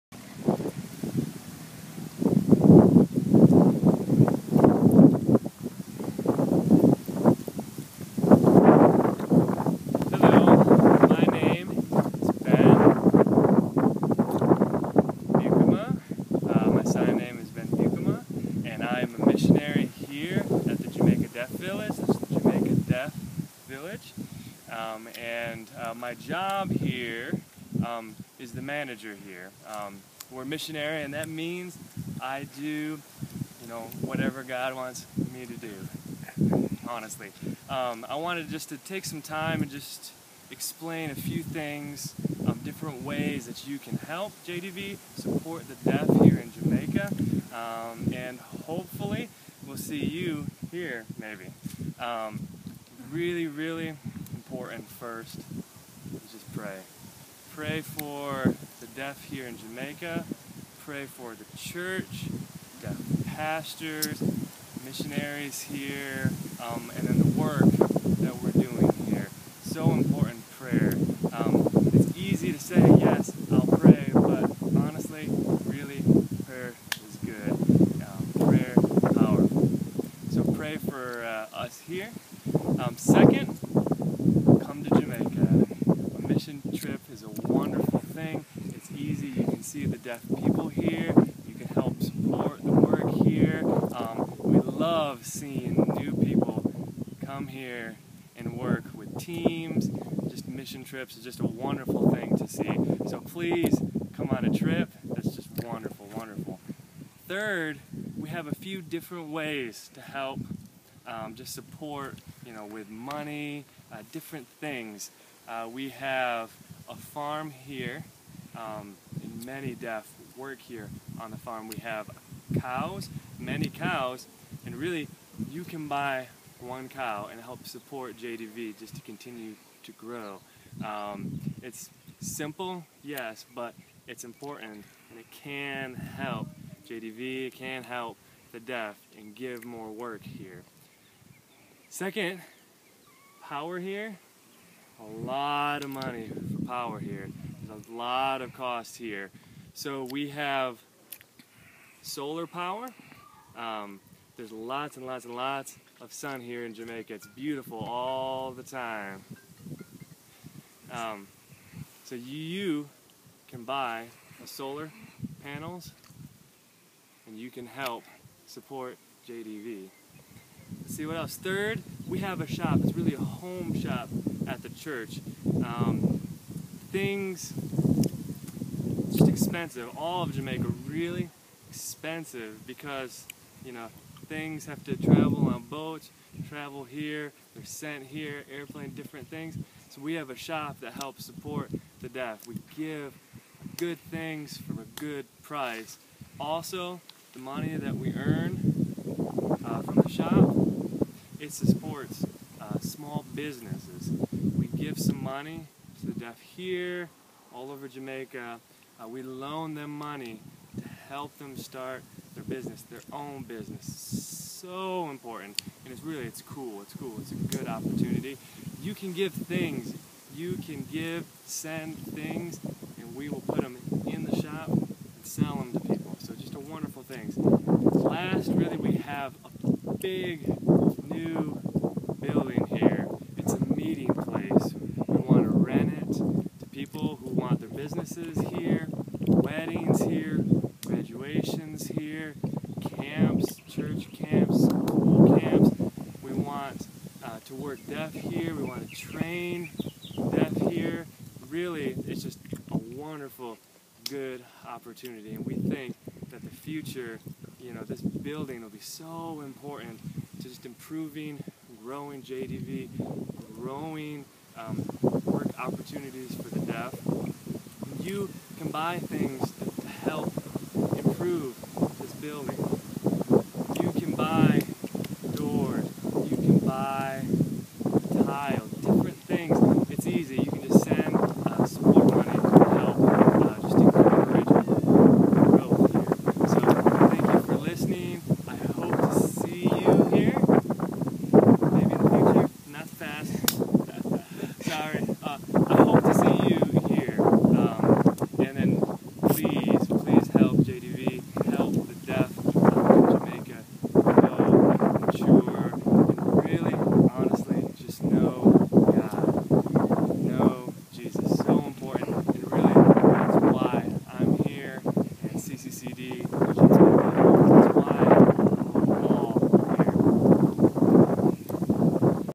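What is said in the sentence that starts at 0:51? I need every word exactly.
Um, really, really important first is just pray.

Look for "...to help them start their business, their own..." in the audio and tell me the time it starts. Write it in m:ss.
3:30.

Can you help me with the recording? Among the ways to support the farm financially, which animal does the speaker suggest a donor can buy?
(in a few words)
cow.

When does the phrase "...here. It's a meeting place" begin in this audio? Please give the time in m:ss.
3:52.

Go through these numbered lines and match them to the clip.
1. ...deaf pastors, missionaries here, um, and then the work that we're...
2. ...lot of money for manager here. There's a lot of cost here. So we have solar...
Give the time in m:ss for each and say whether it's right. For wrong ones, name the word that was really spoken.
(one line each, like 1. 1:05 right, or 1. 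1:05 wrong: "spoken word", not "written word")
1. 1:02 right
2. 2:25 wrong: "power", not "manager".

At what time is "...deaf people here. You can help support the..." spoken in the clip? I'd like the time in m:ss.
1:29.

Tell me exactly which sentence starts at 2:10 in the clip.
Um, it's simple, yes, but it's important and it can help JDV can help the deaf and give more work here.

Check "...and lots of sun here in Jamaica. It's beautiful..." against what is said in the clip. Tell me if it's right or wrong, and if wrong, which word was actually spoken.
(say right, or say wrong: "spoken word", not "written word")
right.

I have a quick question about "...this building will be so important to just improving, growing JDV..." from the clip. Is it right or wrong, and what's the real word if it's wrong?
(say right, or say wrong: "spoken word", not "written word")
right.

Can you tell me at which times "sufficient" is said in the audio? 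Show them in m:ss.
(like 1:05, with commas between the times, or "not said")
not said.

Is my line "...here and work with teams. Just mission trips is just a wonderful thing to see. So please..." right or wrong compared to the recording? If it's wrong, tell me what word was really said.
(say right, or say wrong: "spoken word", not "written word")
right.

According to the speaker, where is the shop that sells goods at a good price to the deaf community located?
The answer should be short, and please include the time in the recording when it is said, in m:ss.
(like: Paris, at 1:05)
at the church, at 2:54.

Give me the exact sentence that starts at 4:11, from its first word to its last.
Really, it's just a wonderful, good opportunity.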